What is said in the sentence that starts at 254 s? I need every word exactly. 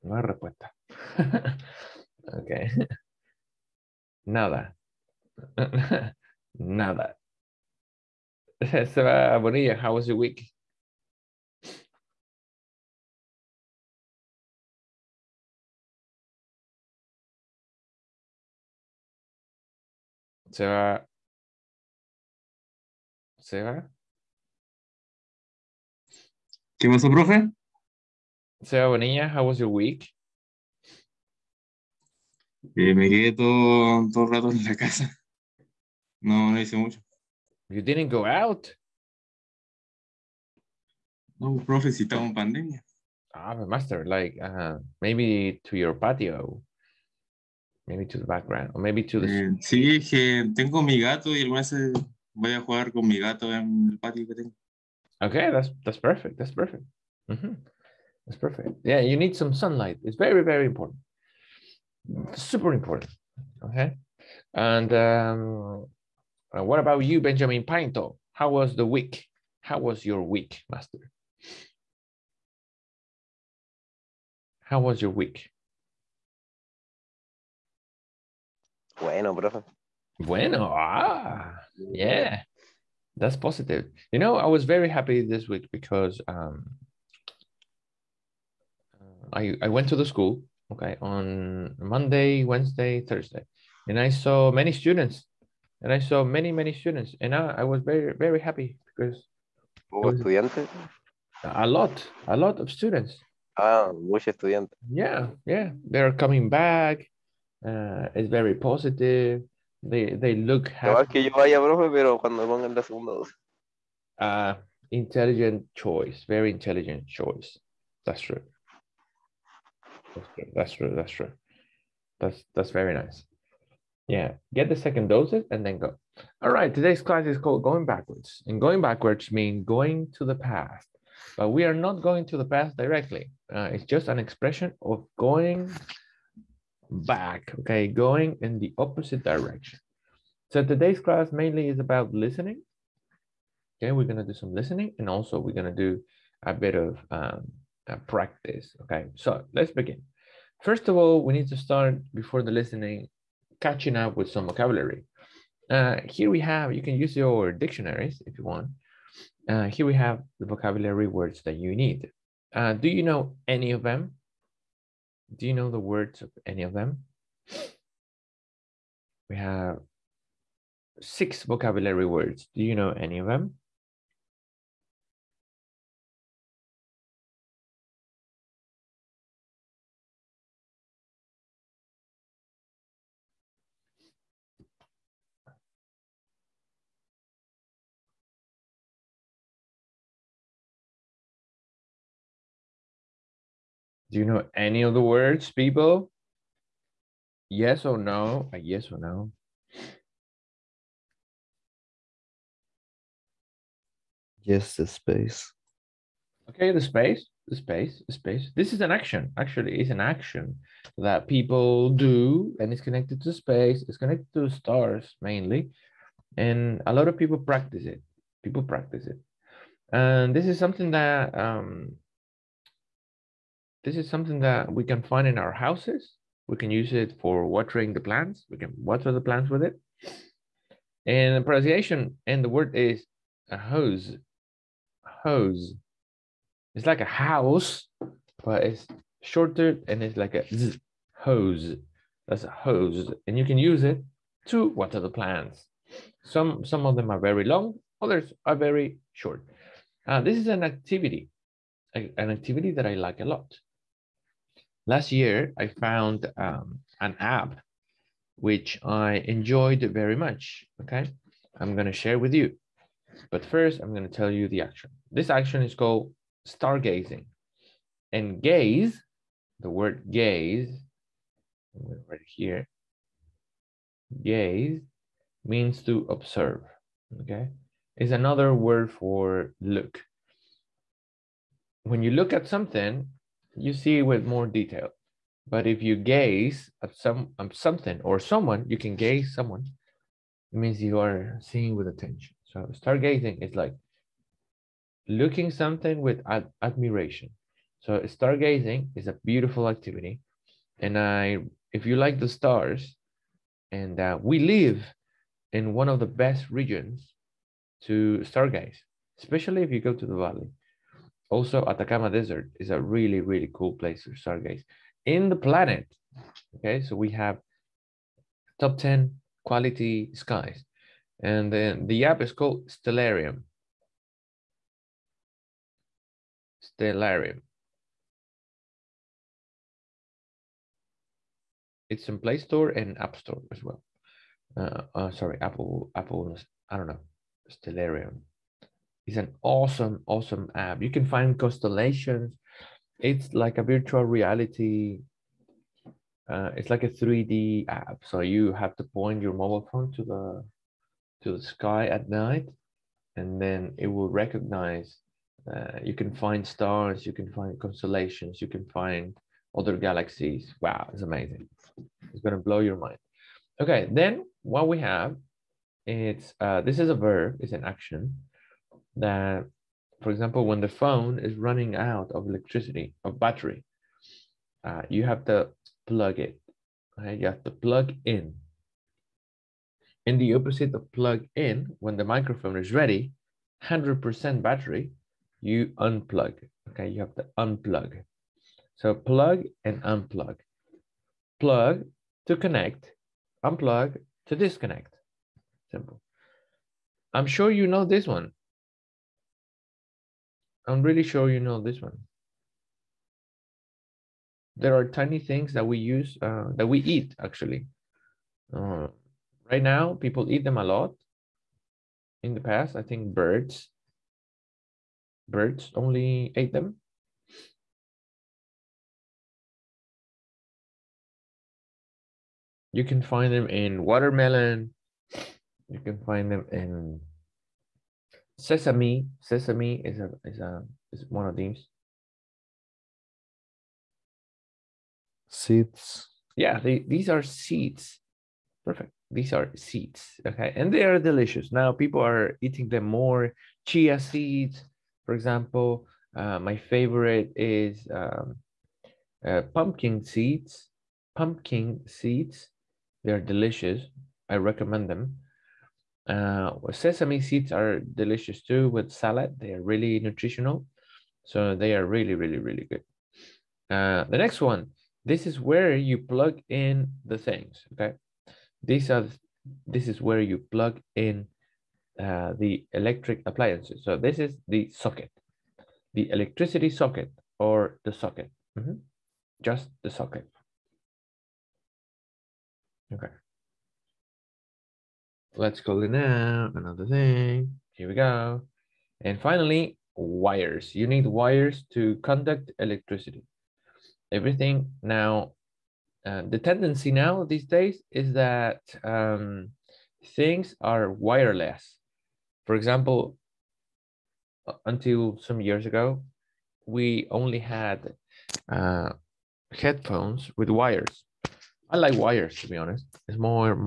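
Last year, I found um, an app which I enjoyed very much, okay?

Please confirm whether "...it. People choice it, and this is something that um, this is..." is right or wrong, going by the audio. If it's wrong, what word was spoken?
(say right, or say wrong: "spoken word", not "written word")
wrong: "practice", not "choice".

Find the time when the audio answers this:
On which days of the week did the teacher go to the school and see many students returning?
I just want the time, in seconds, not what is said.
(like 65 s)
91 s.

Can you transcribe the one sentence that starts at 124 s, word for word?
Yeah, get the second doses and then go.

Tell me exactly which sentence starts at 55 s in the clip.
Okay, that's, that's perfect, that's perfect.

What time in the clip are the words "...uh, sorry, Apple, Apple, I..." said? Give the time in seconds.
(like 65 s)
334 s.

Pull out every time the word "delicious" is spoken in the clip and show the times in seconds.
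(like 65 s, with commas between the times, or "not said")
440 s, 453 s, 457 s.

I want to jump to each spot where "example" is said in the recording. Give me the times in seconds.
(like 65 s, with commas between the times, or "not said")
370 s, 445 s, 502 s.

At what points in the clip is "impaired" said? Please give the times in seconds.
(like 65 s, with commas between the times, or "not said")
not said.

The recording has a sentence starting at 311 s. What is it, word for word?
Also, Atacama Desert is a really, really cool place to stargaze in the planet.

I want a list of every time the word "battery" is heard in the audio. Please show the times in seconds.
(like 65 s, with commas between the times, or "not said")
373 s, 384 s.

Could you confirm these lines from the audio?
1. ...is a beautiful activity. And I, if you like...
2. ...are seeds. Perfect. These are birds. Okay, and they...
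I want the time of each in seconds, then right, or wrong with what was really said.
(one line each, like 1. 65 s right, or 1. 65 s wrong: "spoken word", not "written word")
1. 298 s right
2. 437 s wrong: "seeds", not "birds".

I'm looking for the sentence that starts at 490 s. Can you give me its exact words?
You need wires to conduct electricity.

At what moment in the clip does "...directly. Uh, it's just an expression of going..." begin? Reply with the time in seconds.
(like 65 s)
132 s.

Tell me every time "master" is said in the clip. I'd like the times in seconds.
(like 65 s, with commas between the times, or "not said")
43 s, 70 s.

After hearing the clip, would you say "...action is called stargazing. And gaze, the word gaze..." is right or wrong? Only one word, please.
right.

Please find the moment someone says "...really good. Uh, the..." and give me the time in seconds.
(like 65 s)
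462 s.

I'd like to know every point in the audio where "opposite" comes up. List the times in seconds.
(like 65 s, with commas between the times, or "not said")
138 s, 380 s.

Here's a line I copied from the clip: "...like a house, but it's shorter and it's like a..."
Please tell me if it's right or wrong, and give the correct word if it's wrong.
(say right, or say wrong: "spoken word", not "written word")
right.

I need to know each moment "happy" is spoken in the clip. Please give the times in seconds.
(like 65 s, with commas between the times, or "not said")
84 s, 98 s, 110 s.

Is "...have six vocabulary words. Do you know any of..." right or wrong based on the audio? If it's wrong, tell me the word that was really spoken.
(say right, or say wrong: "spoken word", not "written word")
right.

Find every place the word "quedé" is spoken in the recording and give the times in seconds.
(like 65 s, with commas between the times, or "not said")
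33 s.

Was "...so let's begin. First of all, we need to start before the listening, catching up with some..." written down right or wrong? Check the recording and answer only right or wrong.
right.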